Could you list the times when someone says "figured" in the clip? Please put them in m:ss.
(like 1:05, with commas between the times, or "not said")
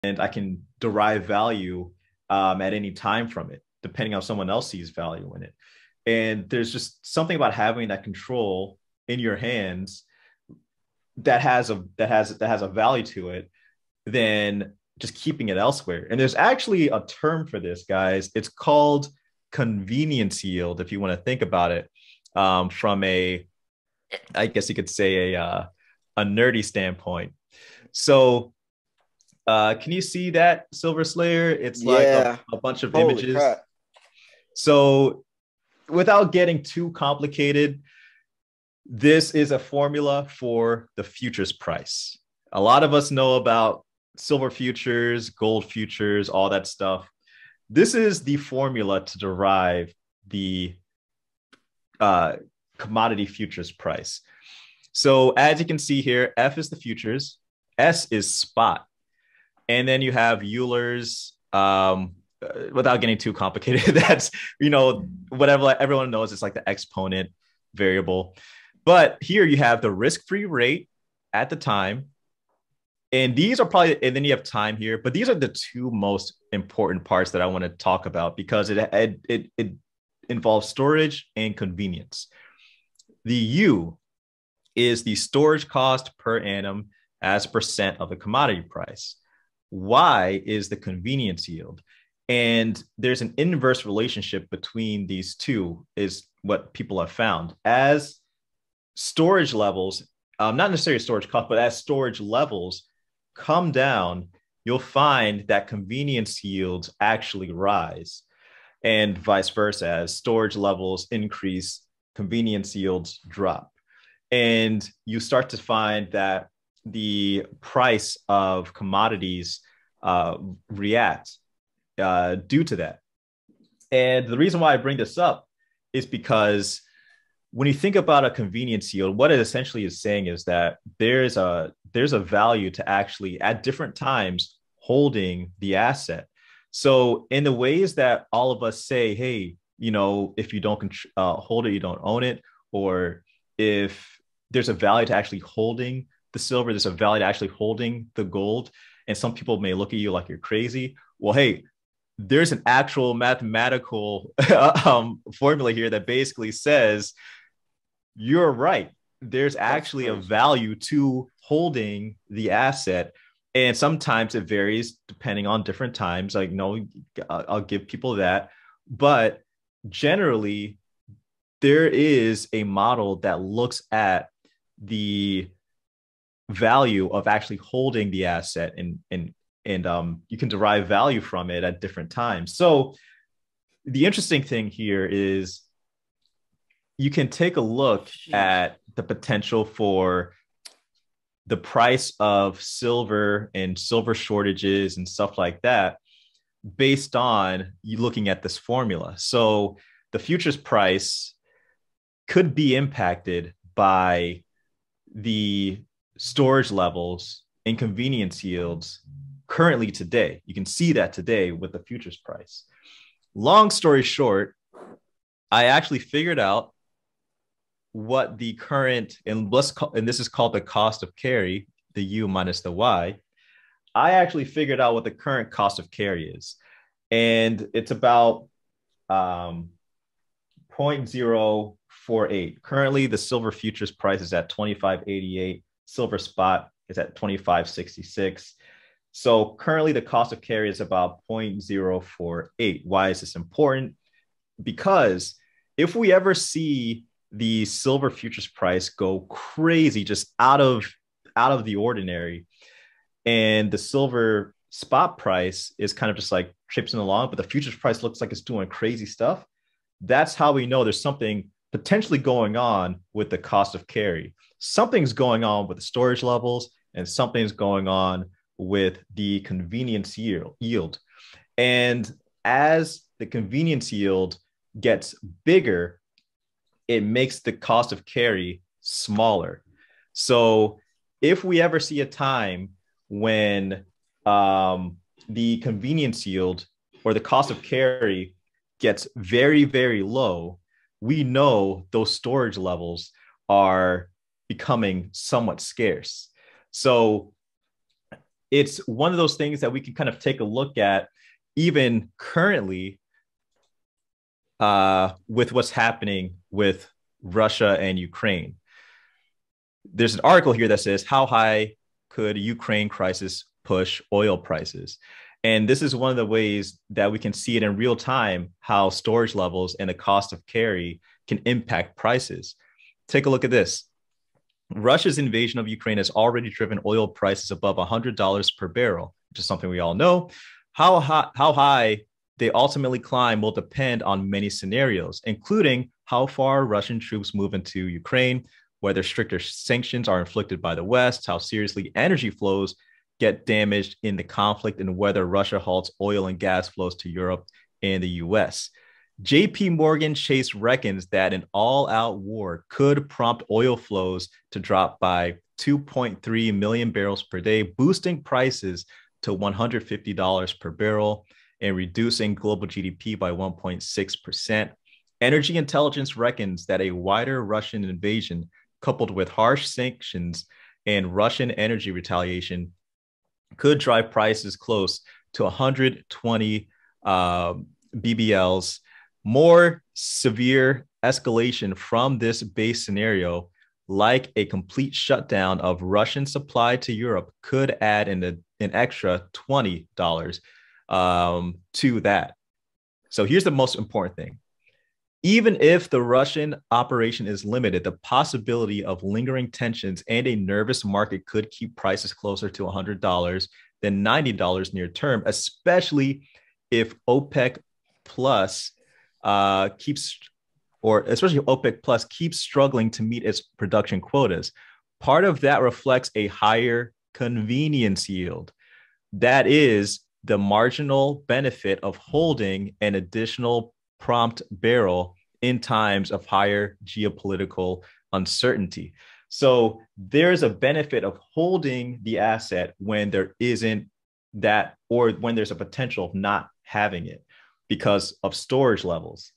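3:35, 3:44.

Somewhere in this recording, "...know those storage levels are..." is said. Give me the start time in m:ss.
4:51.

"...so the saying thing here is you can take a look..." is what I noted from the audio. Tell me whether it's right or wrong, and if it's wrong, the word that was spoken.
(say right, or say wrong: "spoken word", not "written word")
wrong: "interesting", not "saying".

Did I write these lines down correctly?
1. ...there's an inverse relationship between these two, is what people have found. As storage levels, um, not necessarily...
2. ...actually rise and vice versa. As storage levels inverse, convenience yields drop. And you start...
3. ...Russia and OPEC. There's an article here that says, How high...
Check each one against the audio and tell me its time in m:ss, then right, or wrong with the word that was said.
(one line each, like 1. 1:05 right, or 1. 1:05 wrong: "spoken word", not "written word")
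1. 1:32 right
2. 1:46 wrong: "increase", not "inverse"
3. 5:07 wrong: "Ukraine", not "OPEC".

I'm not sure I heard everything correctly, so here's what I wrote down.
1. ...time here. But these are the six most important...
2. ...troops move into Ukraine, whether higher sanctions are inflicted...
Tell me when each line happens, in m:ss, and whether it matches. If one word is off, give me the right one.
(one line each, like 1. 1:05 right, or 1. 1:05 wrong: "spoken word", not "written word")
1. 1:14 wrong: "two", not "six"
2. 5:36 wrong: "stricter", not "higher".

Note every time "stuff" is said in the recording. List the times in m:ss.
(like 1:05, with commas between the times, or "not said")
0:46, 3:15, 4:19.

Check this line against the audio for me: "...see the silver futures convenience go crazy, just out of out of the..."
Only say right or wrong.
wrong.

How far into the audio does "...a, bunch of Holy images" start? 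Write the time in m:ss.
0:32.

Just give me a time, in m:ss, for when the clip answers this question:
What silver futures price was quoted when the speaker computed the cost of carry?
3:54.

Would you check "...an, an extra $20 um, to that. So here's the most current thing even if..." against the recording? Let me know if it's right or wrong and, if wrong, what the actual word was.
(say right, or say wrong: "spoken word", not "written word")
wrong: "important", not "current".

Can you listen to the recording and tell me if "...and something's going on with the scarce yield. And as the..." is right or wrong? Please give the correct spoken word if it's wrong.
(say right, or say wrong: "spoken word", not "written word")
wrong: "convenience", not "scarce".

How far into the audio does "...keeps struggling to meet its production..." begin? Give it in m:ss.
6:52.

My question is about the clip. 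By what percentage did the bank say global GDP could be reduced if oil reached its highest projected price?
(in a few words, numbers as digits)
1.6%.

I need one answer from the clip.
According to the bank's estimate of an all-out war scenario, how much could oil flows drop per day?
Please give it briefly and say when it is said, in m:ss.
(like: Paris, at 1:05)
2.3 million barrels, at 5:55.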